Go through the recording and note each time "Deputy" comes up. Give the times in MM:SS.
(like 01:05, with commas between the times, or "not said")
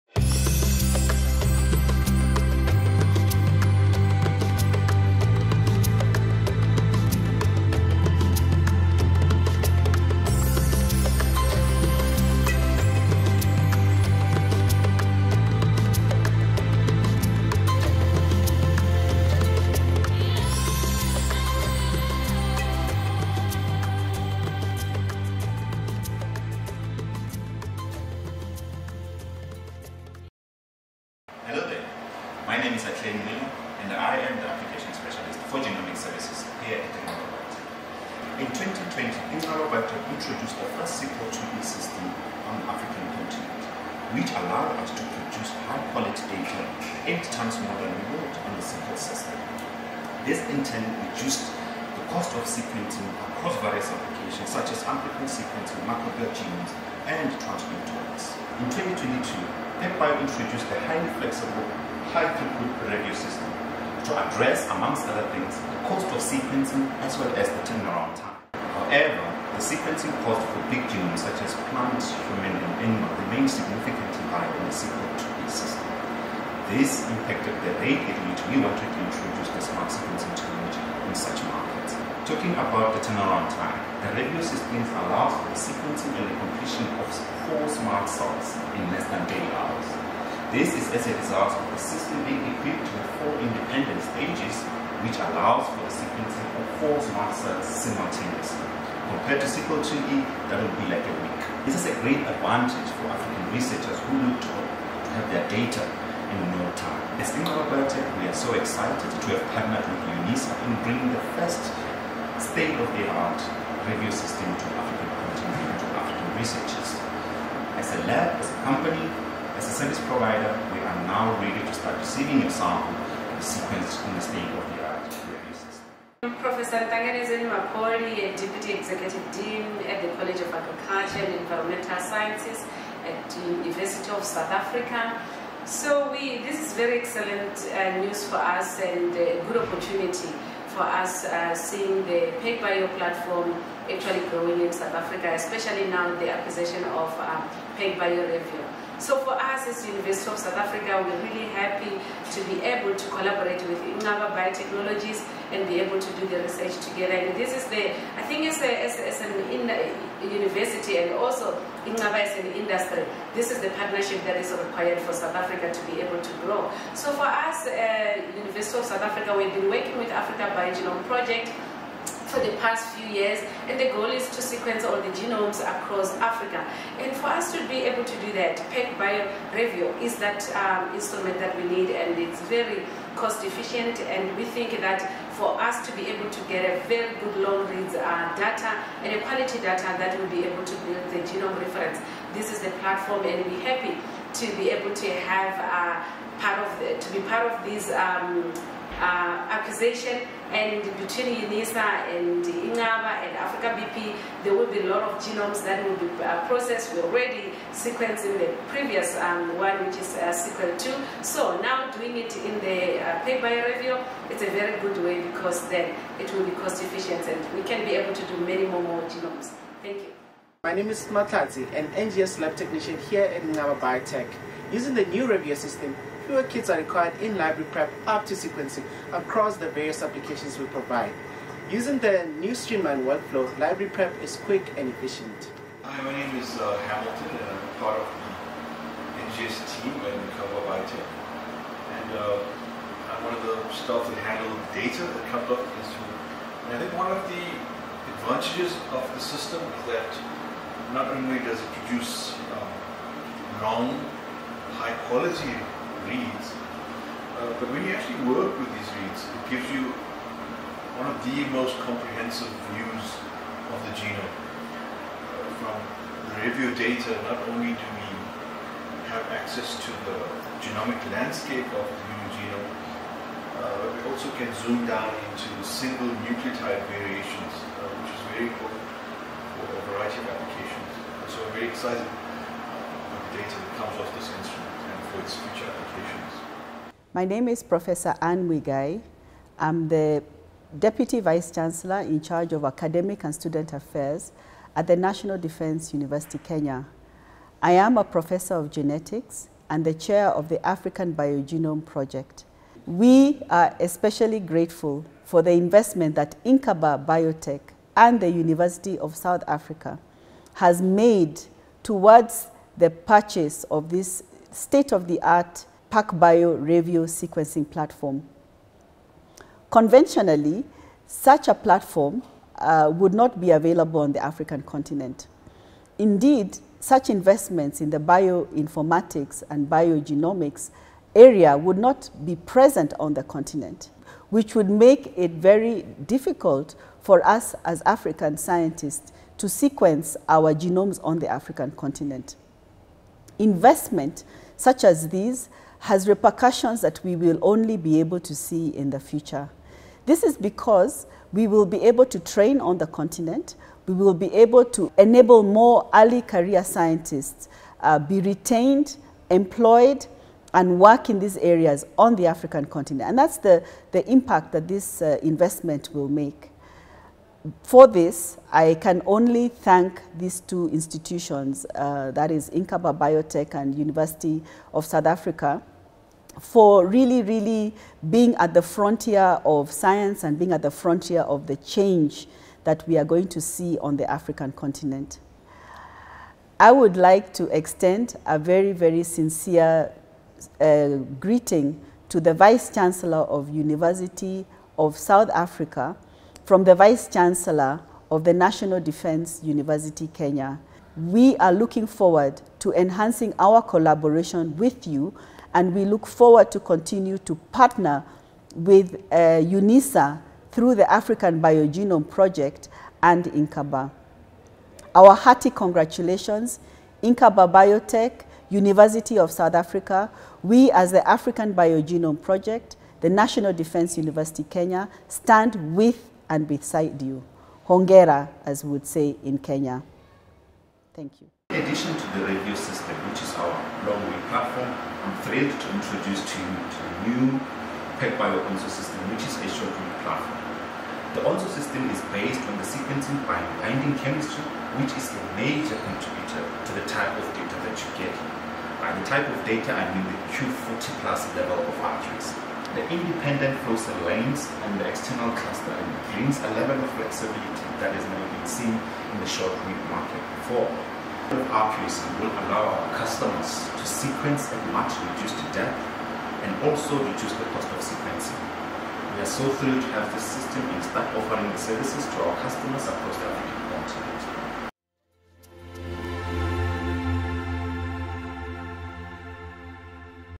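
02:08, 04:50.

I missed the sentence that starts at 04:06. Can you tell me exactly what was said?
And I think one of the advantages of the system is that not only does it produce um, high quality reads.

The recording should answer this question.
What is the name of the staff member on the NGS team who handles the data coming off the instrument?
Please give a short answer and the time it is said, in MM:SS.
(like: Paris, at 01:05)
Hamilton, at 03:56.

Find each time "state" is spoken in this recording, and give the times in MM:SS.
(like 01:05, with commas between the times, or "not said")
01:52, 02:04, 05:14.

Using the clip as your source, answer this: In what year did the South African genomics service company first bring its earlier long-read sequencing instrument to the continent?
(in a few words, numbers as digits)
2020.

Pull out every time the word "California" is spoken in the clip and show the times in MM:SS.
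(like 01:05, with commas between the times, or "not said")
not said.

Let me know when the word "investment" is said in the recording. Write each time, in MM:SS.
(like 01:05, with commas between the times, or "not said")
05:05, 05:27, 05:43, 06:05.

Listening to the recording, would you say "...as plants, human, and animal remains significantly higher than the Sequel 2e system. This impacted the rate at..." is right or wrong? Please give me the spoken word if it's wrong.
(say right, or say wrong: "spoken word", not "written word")
right.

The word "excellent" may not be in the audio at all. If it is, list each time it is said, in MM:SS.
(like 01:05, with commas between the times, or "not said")
02:16.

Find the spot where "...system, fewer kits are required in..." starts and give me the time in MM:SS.
03:45.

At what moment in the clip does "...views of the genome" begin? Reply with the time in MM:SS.
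04:22.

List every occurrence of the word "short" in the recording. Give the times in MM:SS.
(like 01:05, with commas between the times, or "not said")
07:19, 07:39.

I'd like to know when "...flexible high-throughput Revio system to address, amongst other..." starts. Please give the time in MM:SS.
01:01.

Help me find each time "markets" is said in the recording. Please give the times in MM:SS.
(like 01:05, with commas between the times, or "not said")
01:21, 07:39.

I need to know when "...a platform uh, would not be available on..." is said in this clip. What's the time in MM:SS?
05:21.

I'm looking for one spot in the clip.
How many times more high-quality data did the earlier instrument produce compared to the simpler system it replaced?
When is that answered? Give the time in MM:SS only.
00:47.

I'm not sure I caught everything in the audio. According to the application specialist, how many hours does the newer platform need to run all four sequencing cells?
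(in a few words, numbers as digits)
8 hours.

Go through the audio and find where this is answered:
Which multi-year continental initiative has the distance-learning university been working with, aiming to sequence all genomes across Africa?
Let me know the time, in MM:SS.
02:50.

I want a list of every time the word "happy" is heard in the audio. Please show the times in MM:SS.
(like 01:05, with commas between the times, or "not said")
02:31, 03:13.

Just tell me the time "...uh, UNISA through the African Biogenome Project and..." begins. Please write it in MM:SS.
06:49.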